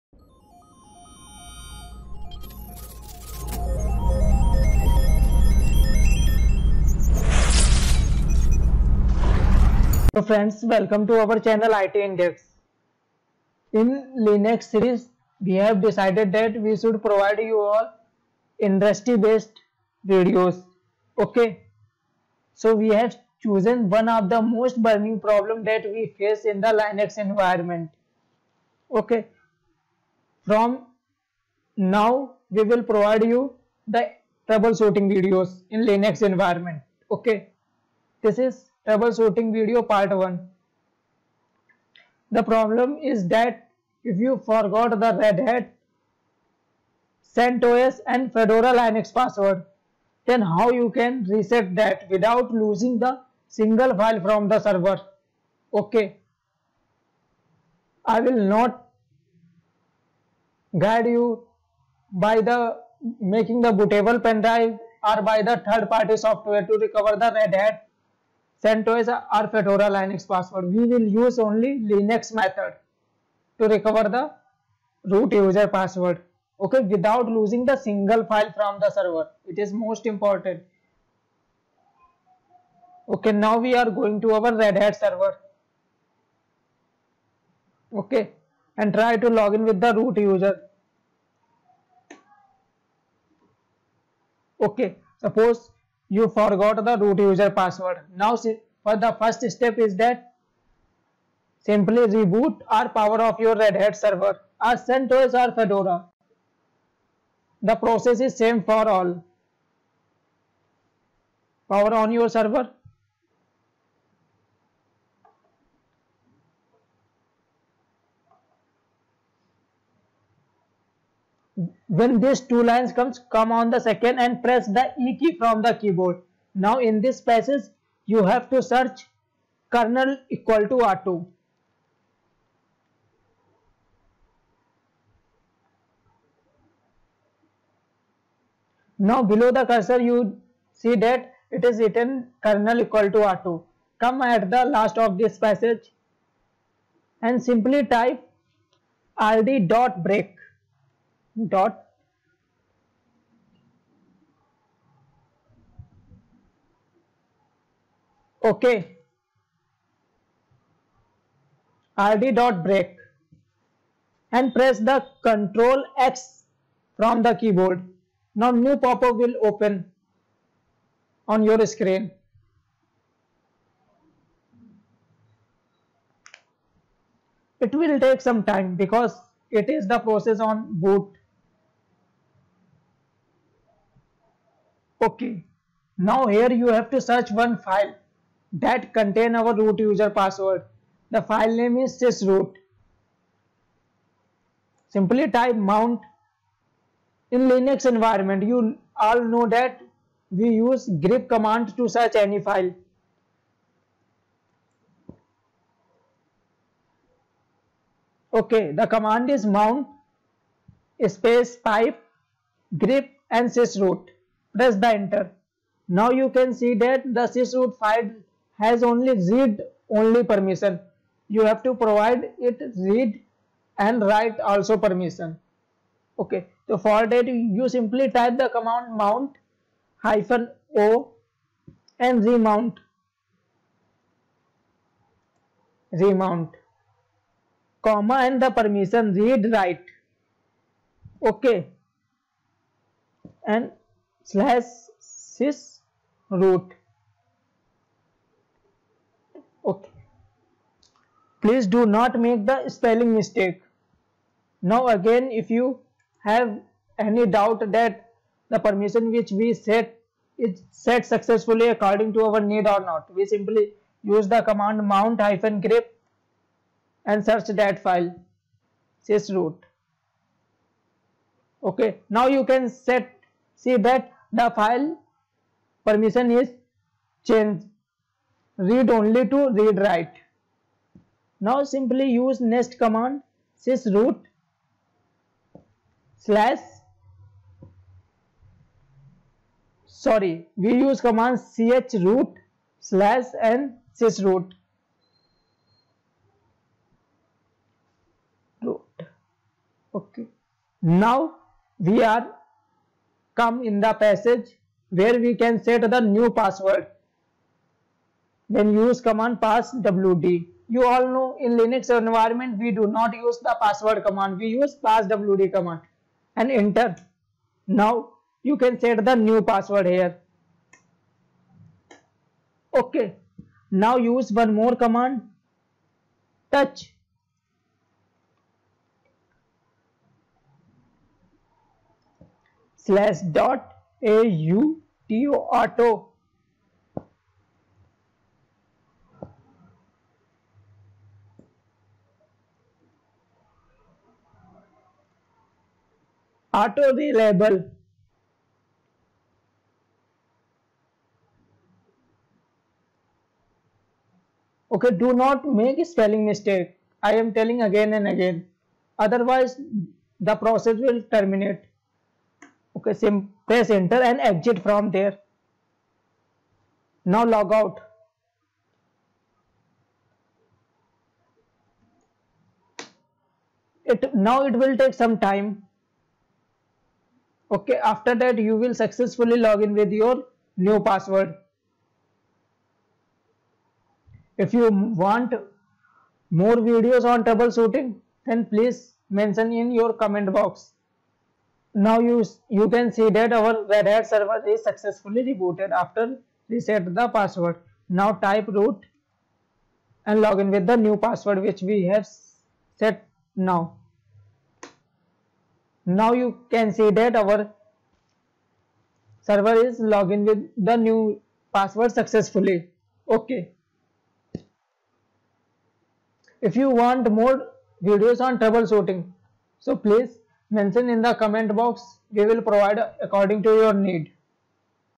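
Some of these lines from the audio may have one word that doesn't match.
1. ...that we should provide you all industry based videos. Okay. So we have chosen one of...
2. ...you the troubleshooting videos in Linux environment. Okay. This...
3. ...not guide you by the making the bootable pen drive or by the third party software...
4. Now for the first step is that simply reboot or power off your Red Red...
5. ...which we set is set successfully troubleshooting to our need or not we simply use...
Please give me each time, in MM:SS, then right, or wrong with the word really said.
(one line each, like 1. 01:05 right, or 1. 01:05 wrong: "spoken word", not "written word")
1. 00:16 right
2. 00:33 right
3. 00:58 right
4. 01:38 wrong: "Hat", not "Red"
5. 04:19 wrong: "according", not "troubleshooting".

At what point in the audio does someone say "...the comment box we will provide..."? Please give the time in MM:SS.
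07:01.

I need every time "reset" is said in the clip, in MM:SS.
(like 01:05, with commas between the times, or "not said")
00:51, 06:36.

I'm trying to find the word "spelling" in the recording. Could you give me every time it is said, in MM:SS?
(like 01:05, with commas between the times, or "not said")
04:12, 05:55.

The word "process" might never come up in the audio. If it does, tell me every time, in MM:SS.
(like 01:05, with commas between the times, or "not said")
01:47, 02:59, 06:00.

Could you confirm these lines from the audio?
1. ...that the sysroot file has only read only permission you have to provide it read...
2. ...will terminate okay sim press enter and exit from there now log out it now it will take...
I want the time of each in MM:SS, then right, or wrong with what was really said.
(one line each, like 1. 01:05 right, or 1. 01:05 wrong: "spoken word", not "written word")
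1. 03:36 right
2. 06:00 right.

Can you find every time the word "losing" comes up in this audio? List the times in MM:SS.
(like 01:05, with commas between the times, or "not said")
00:52, 01:17.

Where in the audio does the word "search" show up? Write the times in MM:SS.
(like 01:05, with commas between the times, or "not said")
02:08, 03:07, 03:21, 04:27.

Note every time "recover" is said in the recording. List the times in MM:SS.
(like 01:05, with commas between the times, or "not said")
01:06, 01:13.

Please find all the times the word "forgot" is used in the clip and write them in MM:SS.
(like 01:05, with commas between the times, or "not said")
00:44, 01:36.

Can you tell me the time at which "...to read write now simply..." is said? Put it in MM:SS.
04:39.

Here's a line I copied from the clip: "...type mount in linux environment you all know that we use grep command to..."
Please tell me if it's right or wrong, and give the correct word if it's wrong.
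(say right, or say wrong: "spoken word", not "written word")
right.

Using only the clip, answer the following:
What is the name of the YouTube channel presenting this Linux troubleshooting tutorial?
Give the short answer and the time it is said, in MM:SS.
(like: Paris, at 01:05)
IT Index, at 00:11.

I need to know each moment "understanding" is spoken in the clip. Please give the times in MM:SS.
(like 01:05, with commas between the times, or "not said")
not said.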